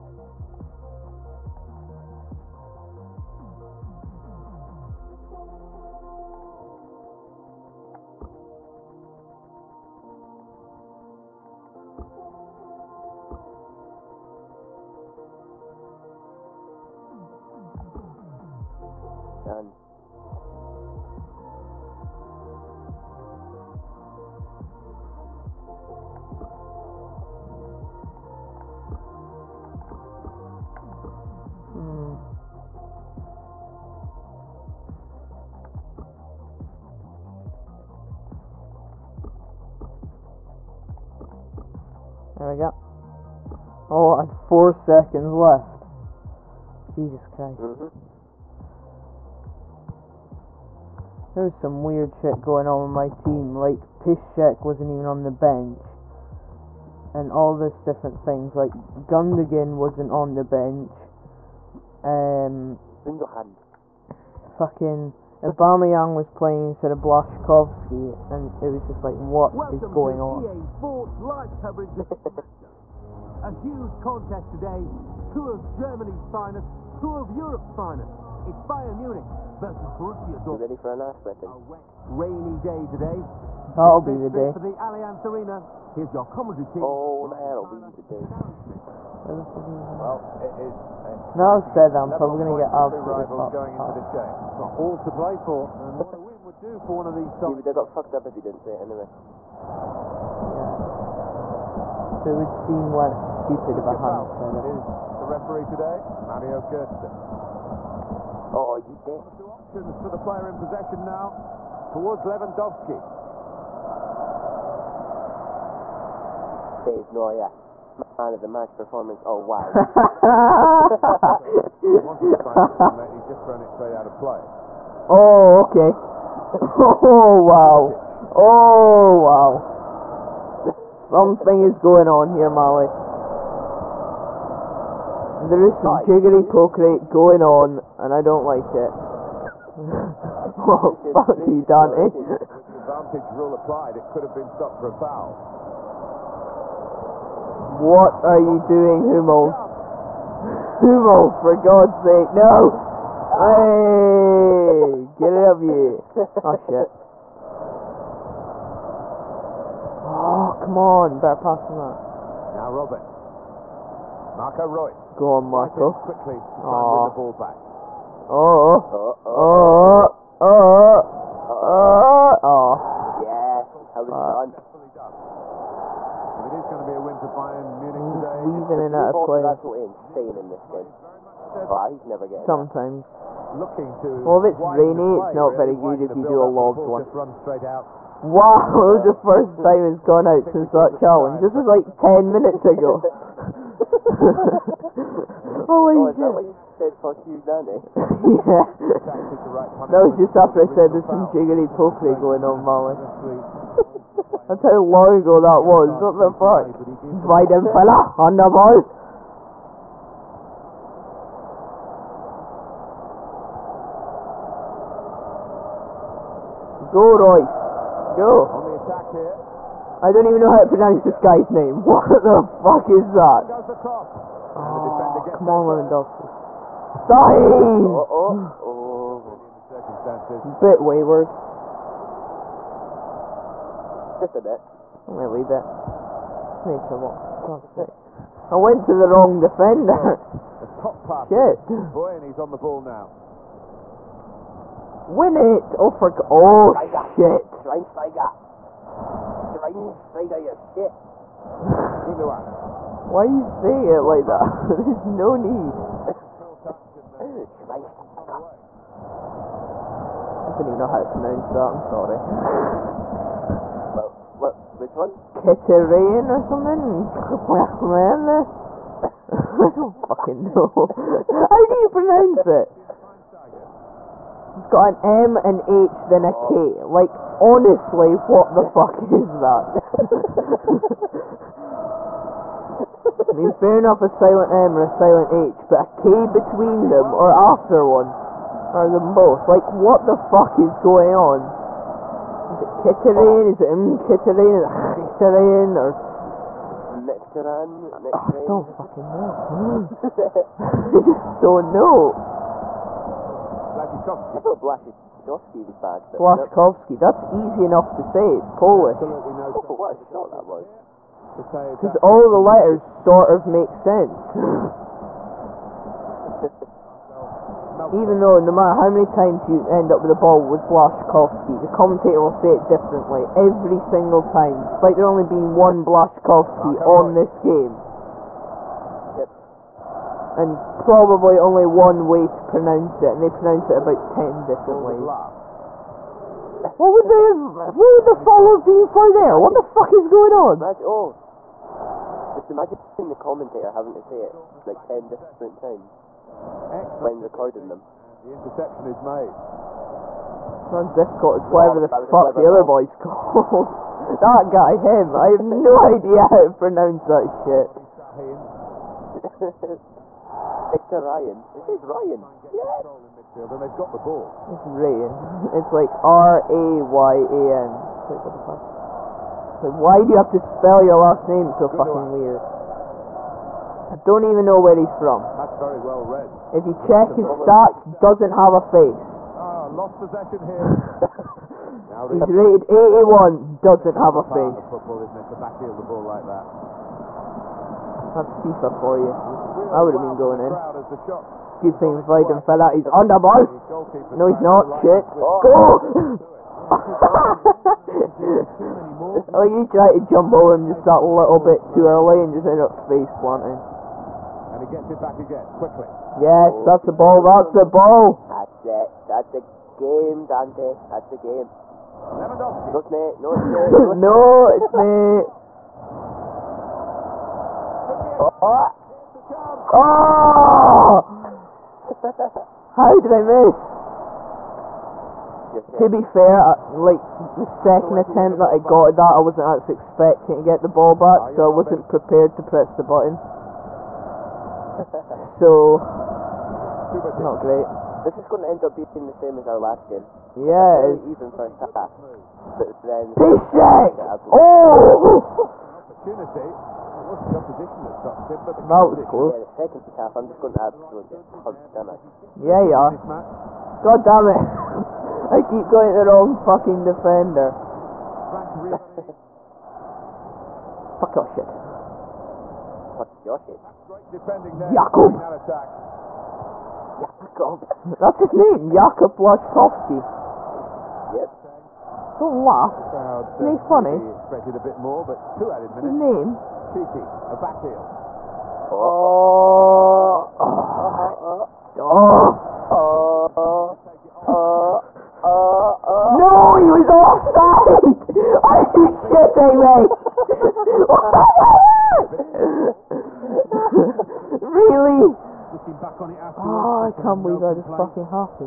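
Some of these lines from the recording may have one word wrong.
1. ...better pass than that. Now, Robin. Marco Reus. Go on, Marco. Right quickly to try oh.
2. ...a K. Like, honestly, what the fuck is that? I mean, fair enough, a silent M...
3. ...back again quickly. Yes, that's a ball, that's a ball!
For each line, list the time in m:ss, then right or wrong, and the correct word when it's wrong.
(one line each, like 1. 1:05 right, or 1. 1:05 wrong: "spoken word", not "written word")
1. 2:41 right
2. 4:36 right
3. 6:44 right.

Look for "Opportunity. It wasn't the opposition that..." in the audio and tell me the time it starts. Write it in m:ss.
7:25.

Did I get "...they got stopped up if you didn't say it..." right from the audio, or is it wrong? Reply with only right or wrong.
wrong.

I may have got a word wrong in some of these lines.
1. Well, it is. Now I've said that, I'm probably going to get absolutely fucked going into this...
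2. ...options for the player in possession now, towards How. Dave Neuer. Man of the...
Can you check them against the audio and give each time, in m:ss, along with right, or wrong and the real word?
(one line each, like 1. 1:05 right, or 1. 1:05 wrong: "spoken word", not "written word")
1. 1:29 right
2. 1:49 wrong: "Lewandowski", not "How".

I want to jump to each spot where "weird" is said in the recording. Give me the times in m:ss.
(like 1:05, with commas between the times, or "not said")
0:51, 6:12.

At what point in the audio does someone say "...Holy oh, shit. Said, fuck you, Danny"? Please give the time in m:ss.
3:15.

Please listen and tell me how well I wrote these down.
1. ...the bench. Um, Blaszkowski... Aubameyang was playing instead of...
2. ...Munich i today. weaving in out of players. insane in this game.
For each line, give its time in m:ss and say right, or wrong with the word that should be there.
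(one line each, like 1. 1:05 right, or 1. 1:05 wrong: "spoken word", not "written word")
1. 1:00 wrong: "Fucking", not "Blaszkowski"
2. 2:57 right.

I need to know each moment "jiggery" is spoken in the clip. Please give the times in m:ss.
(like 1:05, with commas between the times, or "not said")
2:16, 3:21.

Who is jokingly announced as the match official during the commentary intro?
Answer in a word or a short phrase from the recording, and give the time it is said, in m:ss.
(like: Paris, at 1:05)
Mario Götze, at 1:46.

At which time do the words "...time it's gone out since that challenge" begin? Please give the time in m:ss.
3:09.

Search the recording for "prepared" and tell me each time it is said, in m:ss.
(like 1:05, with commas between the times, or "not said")
7:11.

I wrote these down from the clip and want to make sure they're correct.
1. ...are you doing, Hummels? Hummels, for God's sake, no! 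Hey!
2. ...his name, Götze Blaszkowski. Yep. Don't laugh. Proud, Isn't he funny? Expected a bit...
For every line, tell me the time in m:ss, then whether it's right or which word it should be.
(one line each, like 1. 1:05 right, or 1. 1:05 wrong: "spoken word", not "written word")
1. 2:28 right
2. 7:48 wrong: "Jakub", not "Götze".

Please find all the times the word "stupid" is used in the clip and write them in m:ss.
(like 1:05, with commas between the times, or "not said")
1:43.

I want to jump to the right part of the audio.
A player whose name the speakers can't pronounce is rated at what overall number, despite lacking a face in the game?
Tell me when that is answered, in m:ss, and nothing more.
6:22.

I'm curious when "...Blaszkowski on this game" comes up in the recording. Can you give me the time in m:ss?
5:25.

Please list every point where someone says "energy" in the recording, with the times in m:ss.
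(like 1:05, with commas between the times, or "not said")
not said.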